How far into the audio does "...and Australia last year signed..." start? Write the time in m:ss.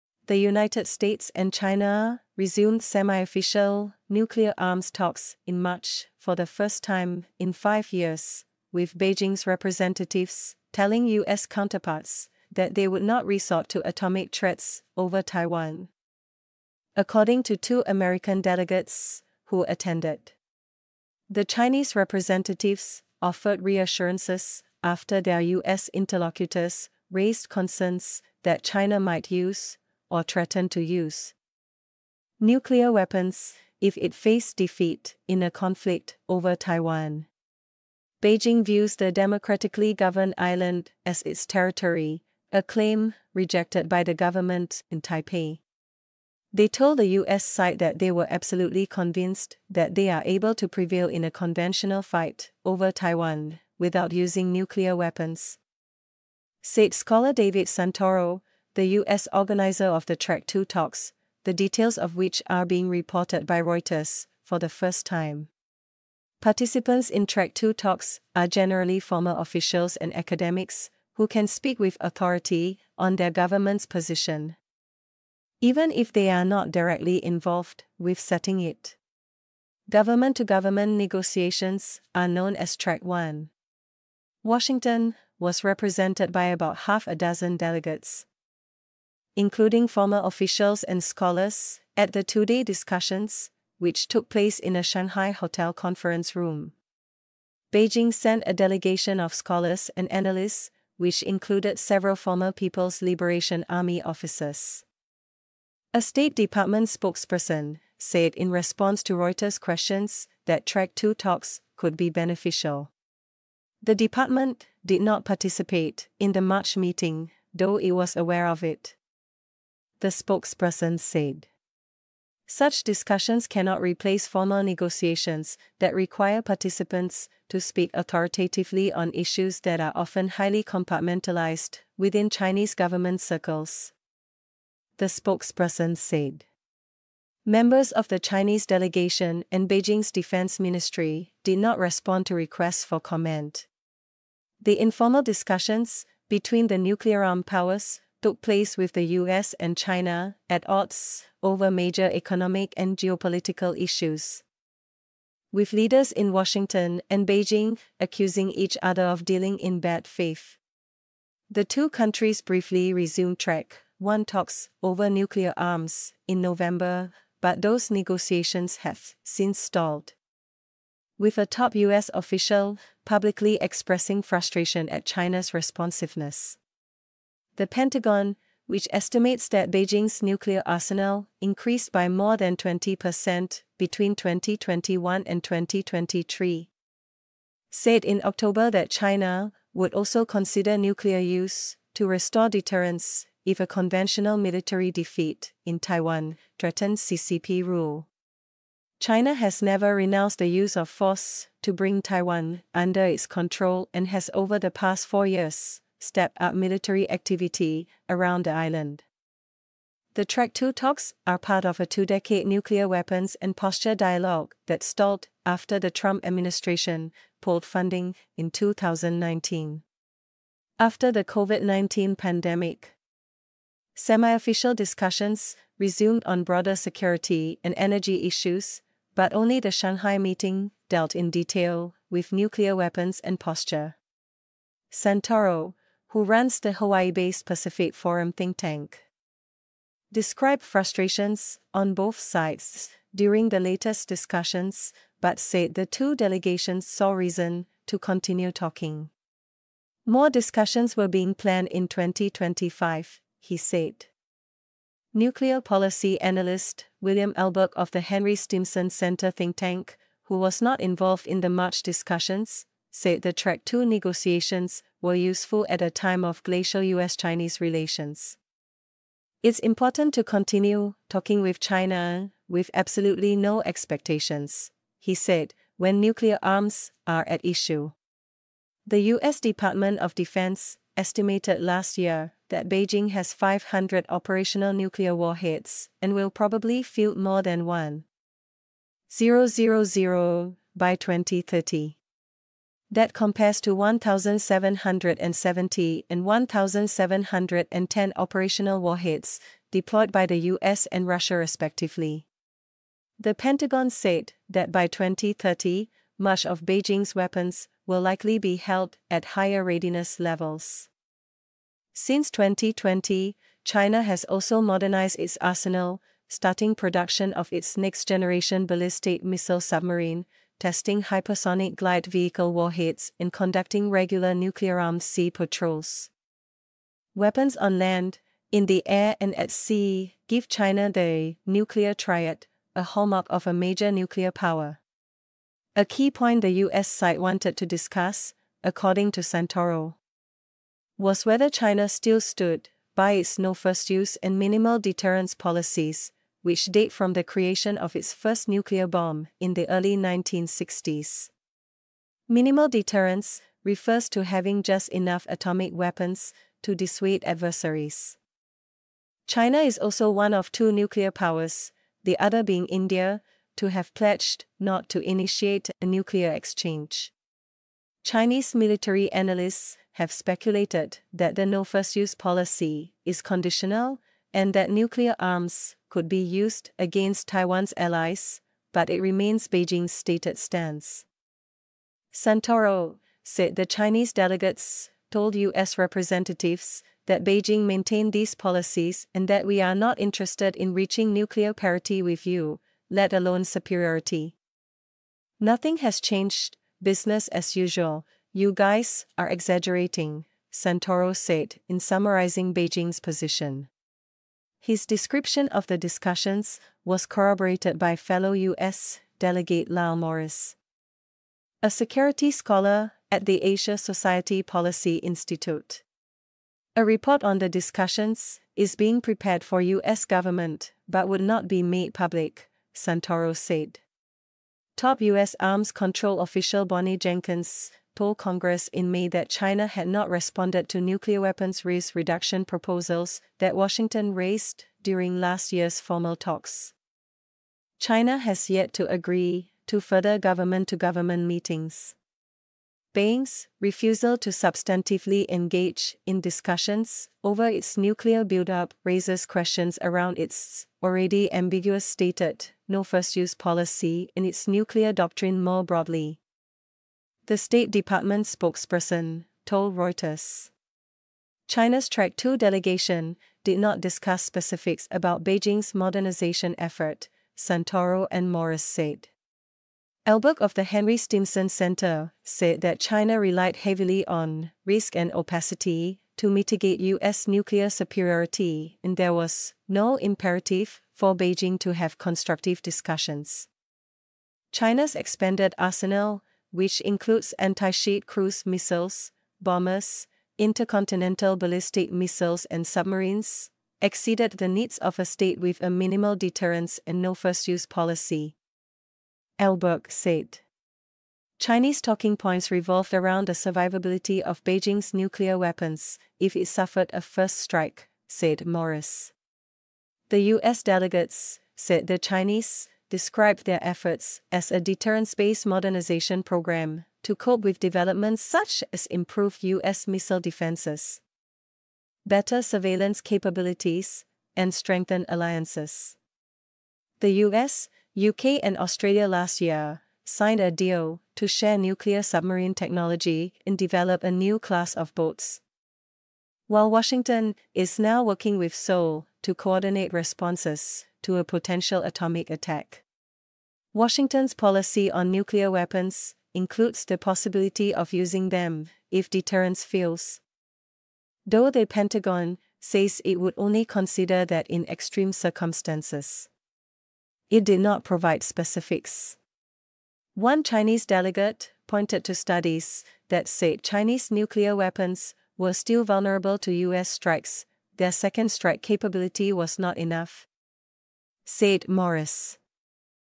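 8:48.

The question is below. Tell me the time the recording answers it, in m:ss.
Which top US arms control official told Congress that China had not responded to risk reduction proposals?
7:06.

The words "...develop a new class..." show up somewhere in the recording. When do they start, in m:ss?
8:53.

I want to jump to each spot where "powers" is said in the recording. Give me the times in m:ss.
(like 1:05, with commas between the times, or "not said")
2:27, 5:34, 6:01.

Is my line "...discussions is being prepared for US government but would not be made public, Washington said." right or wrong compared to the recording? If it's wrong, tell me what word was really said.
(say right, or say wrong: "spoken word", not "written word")
wrong: "Santoro", not "Washington".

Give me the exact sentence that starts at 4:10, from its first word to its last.
More discussions were being planned in 2025, he said.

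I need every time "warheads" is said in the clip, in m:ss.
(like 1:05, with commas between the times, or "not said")
4:45, 4:58, 5:22.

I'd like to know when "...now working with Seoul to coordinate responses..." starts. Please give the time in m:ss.
8:57.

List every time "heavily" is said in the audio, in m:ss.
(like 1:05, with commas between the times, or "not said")
7:53.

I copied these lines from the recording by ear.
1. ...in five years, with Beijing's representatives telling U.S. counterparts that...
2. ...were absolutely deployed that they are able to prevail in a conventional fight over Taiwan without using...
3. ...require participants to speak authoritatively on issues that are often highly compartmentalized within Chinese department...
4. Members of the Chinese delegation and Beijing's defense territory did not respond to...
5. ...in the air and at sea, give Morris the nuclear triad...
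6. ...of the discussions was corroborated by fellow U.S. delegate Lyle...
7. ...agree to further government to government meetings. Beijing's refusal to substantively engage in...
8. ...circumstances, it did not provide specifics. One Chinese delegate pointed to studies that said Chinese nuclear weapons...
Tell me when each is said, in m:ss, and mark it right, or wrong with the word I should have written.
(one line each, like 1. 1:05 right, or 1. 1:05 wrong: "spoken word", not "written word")
1. 0:07 right
2. 0:48 wrong: "convinced", not "deployed"
3. 2:05 wrong: "government", not "department"
4. 2:17 wrong: "ministry", not "territory"
5. 5:28 wrong: "China", not "Morris"
6. 6:45 right
7. 7:18 right
8. 9:15 right.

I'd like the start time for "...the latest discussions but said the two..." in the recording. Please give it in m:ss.
4:03.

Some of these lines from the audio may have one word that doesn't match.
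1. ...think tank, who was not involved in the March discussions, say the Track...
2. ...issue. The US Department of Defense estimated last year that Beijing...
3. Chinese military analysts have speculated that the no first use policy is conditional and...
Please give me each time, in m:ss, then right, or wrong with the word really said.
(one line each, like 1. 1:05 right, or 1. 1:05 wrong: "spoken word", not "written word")
1. 4:19 right
2. 4:37 right
3. 6:08 right.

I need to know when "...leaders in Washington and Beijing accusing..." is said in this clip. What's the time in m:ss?
2:35.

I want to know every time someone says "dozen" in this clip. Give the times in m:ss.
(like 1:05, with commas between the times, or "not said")
1:27.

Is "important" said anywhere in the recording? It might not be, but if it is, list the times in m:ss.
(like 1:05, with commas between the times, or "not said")
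4:29.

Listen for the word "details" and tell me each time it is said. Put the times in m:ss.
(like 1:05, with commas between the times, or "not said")
1:01, 3:51.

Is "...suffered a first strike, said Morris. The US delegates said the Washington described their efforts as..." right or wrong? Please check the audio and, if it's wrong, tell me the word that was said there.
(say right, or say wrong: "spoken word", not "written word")
wrong: "Chinese", not "Washington".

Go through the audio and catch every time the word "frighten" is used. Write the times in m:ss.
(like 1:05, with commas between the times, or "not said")
not said.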